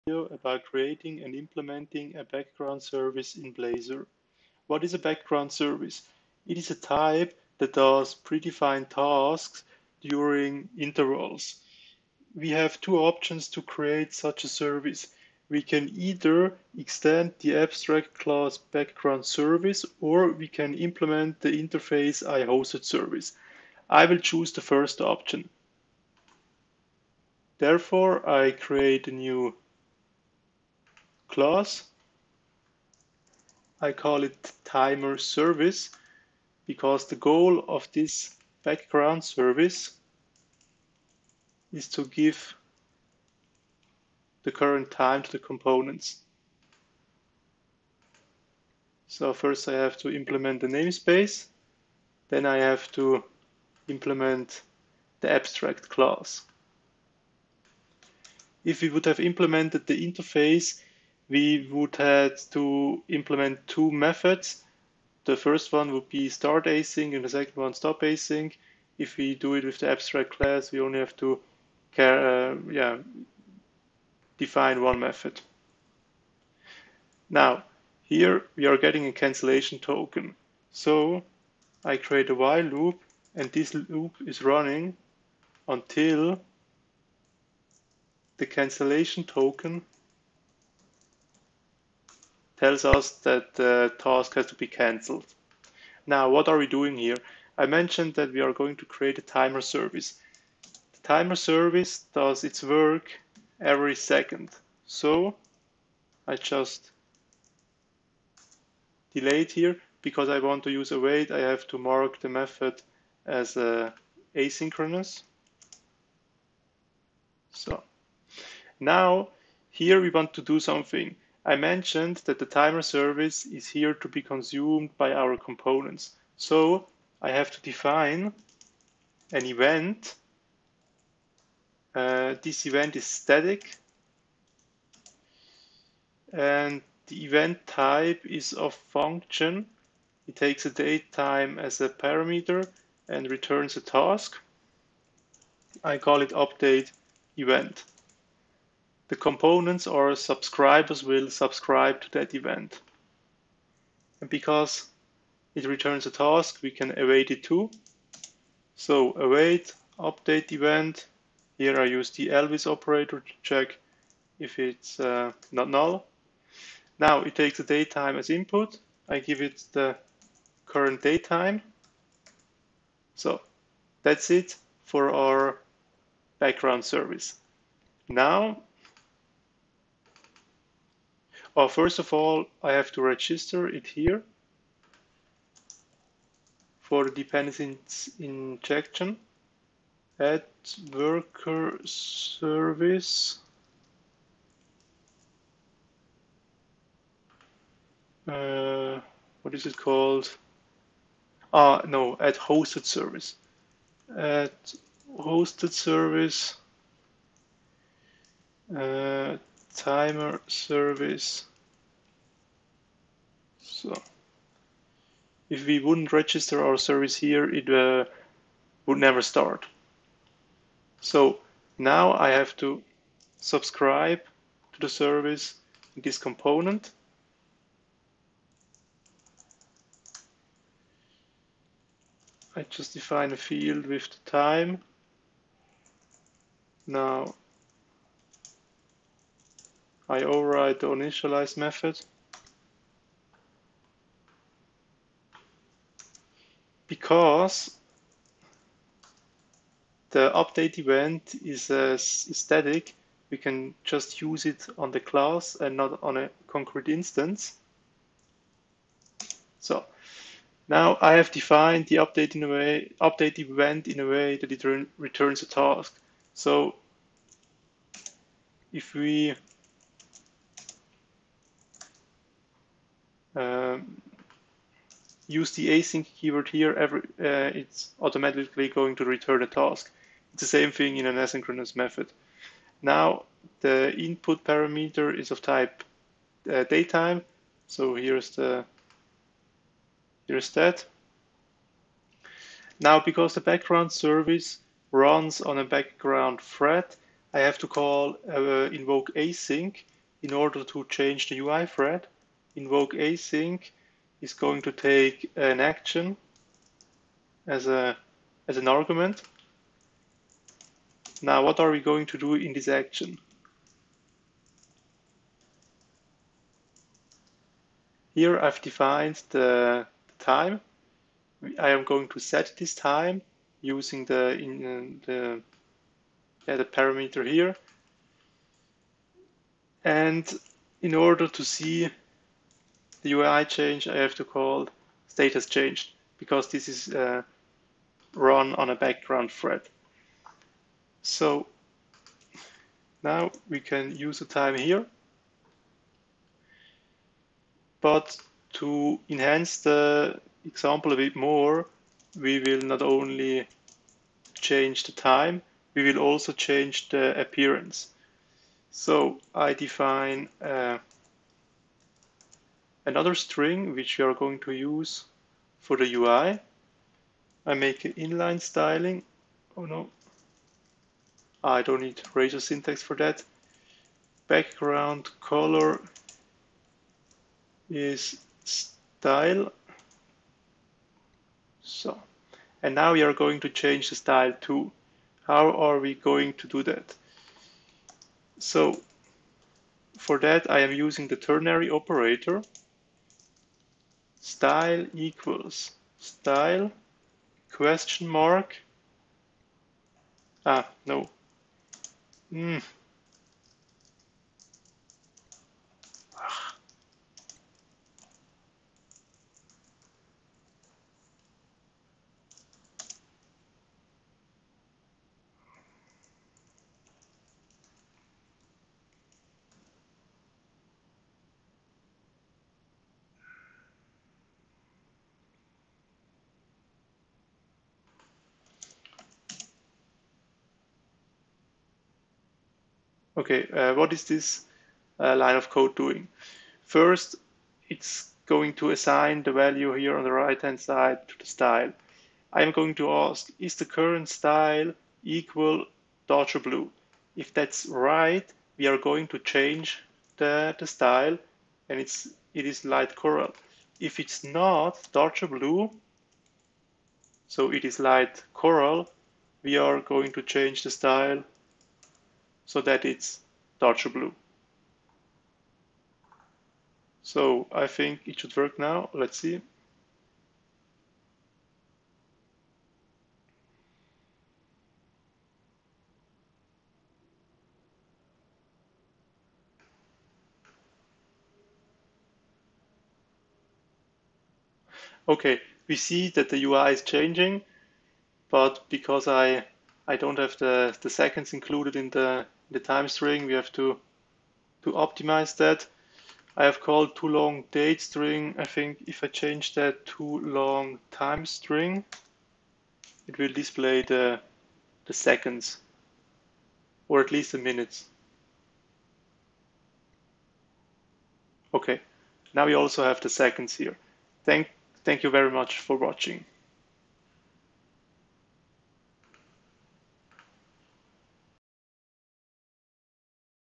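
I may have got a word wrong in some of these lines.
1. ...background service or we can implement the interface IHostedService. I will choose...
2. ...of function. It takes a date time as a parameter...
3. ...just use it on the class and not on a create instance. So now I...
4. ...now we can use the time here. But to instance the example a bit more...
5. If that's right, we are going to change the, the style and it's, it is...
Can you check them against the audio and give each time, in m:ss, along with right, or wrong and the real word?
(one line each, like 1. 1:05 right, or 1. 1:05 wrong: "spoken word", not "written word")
1. 0:18 right
2. 2:18 right
3. 4:13 wrong: "concrete", not "create"
4. 5:43 wrong: "enhance", not "instance"
5. 7:27 right.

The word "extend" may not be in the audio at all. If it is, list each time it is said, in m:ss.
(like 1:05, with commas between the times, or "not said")
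0:16.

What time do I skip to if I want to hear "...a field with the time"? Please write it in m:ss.
3:53.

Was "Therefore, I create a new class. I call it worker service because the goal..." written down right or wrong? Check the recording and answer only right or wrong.
wrong.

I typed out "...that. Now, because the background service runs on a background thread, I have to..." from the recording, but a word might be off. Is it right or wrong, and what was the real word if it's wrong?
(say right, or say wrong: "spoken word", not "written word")
right.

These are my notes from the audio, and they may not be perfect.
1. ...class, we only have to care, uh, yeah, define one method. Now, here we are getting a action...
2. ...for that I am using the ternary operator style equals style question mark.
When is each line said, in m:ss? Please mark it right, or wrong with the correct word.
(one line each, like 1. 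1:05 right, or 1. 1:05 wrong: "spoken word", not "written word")
1. 1:10 wrong: "cancellation", not "action"
2. 6:30 right.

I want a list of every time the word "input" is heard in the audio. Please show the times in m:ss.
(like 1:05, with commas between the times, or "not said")
2:48, 4:43.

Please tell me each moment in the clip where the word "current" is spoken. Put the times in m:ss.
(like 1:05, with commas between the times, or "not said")
0:44, 2:50, 7:23.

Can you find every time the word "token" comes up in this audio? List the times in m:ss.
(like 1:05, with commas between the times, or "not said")
1:19, 1:29.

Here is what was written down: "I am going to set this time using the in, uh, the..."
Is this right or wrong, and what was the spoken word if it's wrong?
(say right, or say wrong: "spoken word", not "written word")
right.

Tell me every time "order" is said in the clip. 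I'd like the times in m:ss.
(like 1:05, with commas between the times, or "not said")
5:00, 5:30.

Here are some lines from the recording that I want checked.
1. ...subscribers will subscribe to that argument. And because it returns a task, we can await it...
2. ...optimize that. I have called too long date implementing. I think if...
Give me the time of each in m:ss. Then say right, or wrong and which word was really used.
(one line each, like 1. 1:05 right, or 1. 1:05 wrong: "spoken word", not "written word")
1. 2:30 wrong: "event", not "argument"
2. 8:14 wrong: "string", not "implementing".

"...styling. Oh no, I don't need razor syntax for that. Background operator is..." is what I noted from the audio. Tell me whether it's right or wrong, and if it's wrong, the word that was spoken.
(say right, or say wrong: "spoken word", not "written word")
wrong: "color", not "operator".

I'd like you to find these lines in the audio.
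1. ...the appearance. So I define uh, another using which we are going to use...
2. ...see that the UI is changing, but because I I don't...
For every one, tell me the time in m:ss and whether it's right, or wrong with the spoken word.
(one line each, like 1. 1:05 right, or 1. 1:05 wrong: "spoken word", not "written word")
1. 5:56 wrong: "string", not "using"
2. 8:05 right.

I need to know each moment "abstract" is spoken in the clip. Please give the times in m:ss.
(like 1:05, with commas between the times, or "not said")
0:17, 0:55, 1:09.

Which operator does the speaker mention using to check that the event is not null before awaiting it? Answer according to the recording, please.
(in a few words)
Elvis operator.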